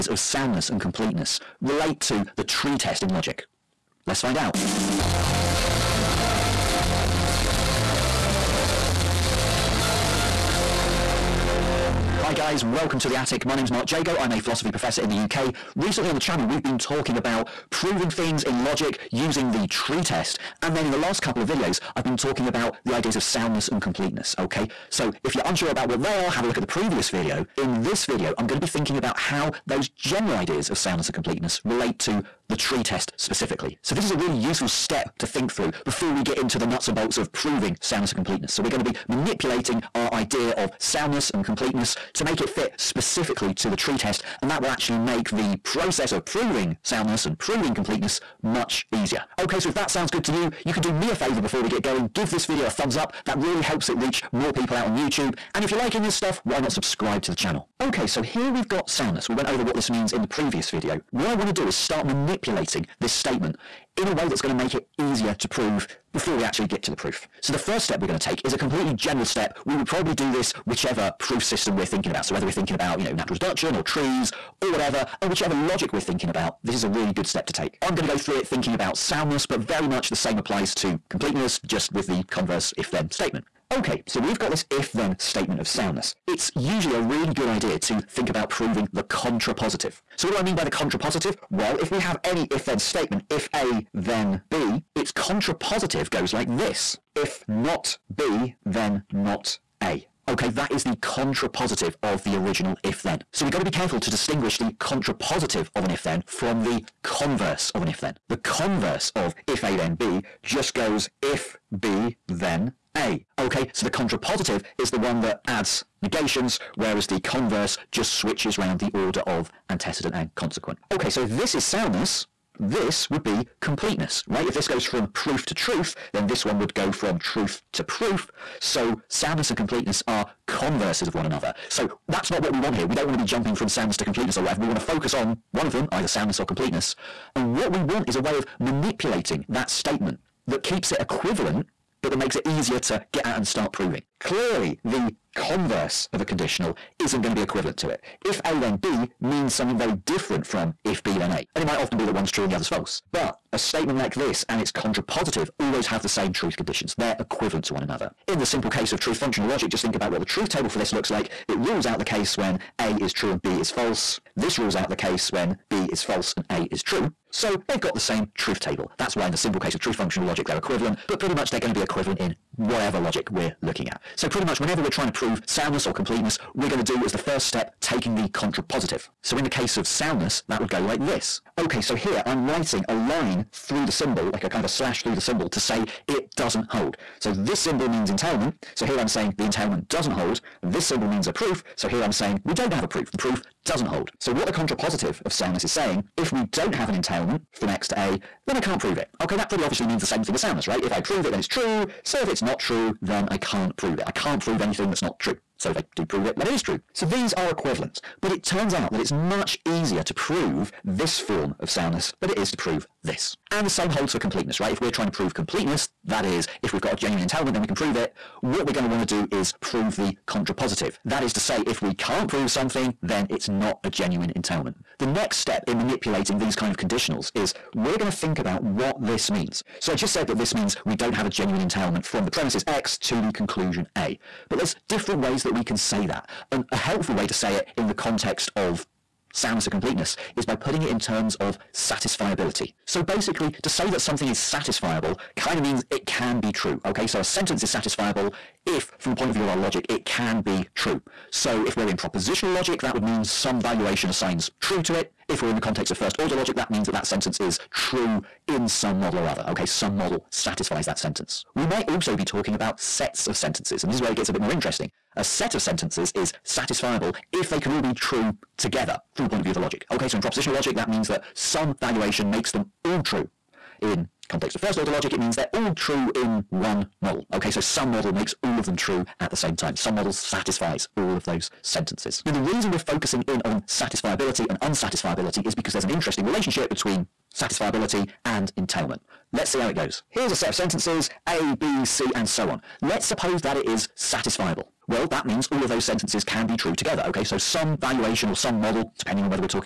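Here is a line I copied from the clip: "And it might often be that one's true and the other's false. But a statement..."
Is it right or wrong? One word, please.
right.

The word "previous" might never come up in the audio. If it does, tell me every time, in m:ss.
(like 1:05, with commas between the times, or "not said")
0:26, 1:00.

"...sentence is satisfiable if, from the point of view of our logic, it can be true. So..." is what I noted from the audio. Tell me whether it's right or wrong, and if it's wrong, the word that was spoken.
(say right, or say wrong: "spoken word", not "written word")
right.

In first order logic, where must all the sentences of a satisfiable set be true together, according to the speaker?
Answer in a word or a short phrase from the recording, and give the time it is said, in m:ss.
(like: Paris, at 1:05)
in one model, at 4:36.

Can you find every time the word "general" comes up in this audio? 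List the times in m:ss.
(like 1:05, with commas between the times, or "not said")
0:29, 1:08.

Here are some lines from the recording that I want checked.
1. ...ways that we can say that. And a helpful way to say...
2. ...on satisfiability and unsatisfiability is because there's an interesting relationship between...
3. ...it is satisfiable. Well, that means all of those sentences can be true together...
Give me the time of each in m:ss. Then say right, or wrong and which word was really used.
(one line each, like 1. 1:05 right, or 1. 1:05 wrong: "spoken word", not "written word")
1. 3:55 right
2. 4:43 right
3. 4:53 right.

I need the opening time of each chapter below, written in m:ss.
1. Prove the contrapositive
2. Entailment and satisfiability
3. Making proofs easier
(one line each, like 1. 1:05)
1. 1:23
2. 3:44
3. 0:57.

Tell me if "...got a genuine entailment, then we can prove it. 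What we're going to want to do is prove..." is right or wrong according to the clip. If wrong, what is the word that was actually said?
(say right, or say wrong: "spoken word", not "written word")
right.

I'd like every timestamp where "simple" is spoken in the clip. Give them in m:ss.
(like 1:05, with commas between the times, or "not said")
2:38, 2:49.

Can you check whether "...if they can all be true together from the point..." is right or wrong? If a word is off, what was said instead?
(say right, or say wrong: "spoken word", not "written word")
right.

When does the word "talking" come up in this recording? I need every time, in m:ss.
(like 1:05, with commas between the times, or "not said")
0:22, 4:22.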